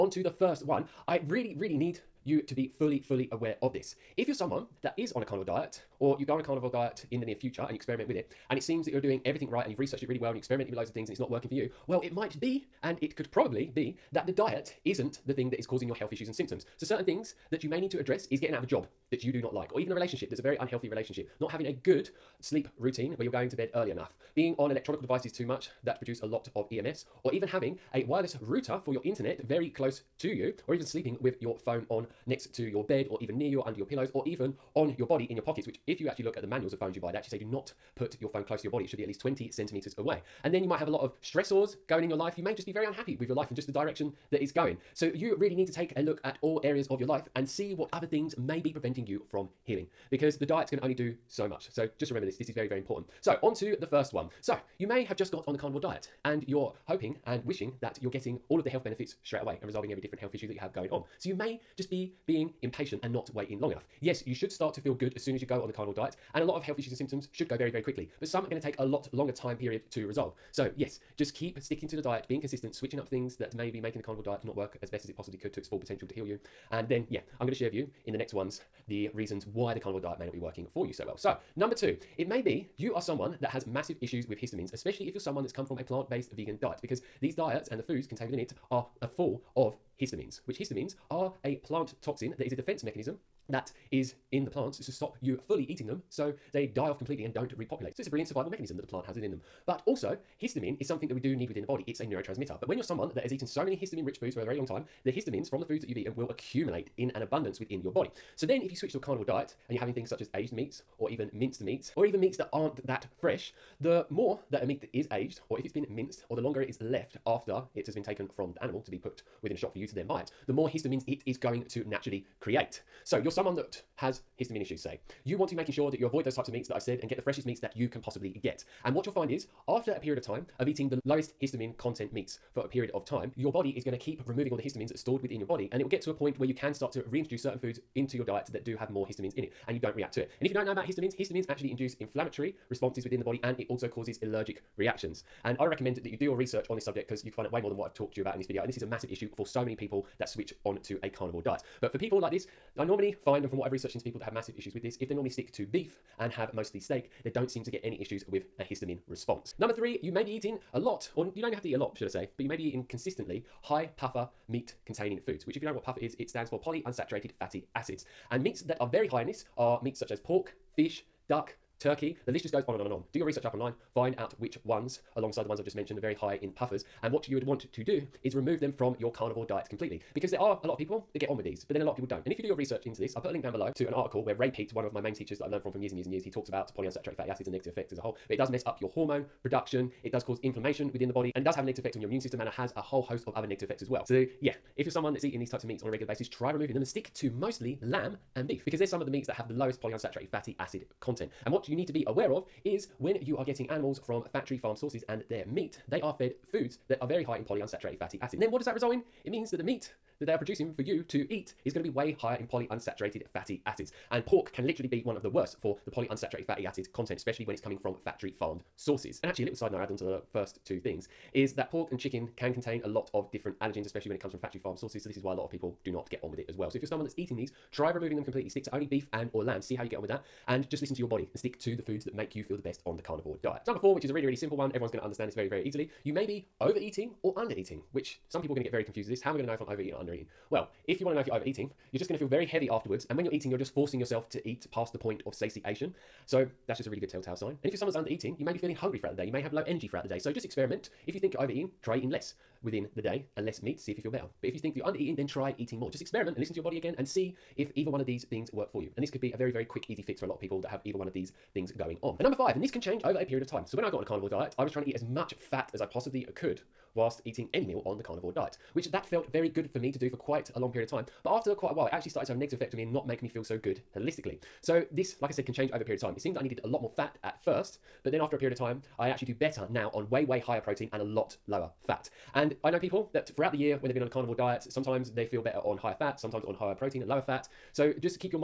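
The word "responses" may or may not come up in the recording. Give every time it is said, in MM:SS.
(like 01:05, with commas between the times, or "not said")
02:22, 02:39.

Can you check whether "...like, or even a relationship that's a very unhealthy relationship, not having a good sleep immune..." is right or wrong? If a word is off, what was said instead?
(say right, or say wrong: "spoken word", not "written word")
wrong: "routine", not "immune".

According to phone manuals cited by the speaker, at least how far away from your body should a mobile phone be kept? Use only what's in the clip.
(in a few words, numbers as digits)
20 centimeters.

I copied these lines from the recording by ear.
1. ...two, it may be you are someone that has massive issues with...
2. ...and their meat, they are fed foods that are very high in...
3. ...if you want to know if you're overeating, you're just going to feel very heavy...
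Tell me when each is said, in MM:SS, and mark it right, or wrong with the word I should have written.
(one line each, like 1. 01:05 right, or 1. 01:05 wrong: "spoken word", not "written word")
1. 01:21 right
2. 03:25 right
3. 04:00 right.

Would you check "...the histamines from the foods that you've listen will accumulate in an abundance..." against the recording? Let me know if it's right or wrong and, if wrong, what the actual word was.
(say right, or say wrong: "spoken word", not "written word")
wrong: "eaten", not "listen".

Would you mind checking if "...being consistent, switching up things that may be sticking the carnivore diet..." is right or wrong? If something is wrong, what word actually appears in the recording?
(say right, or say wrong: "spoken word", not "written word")
wrong: "making", not "sticking".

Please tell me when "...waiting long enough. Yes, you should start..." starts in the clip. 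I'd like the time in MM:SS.
01:03.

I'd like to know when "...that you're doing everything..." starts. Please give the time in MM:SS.
00:08.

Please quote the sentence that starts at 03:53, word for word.
Number four, which is a really, really simple one, everyone's going to understand this very, very easily.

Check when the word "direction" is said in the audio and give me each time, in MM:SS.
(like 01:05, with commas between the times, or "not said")
00:43.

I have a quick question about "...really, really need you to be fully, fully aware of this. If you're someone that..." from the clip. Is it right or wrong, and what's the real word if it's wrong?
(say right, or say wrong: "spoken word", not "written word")
right.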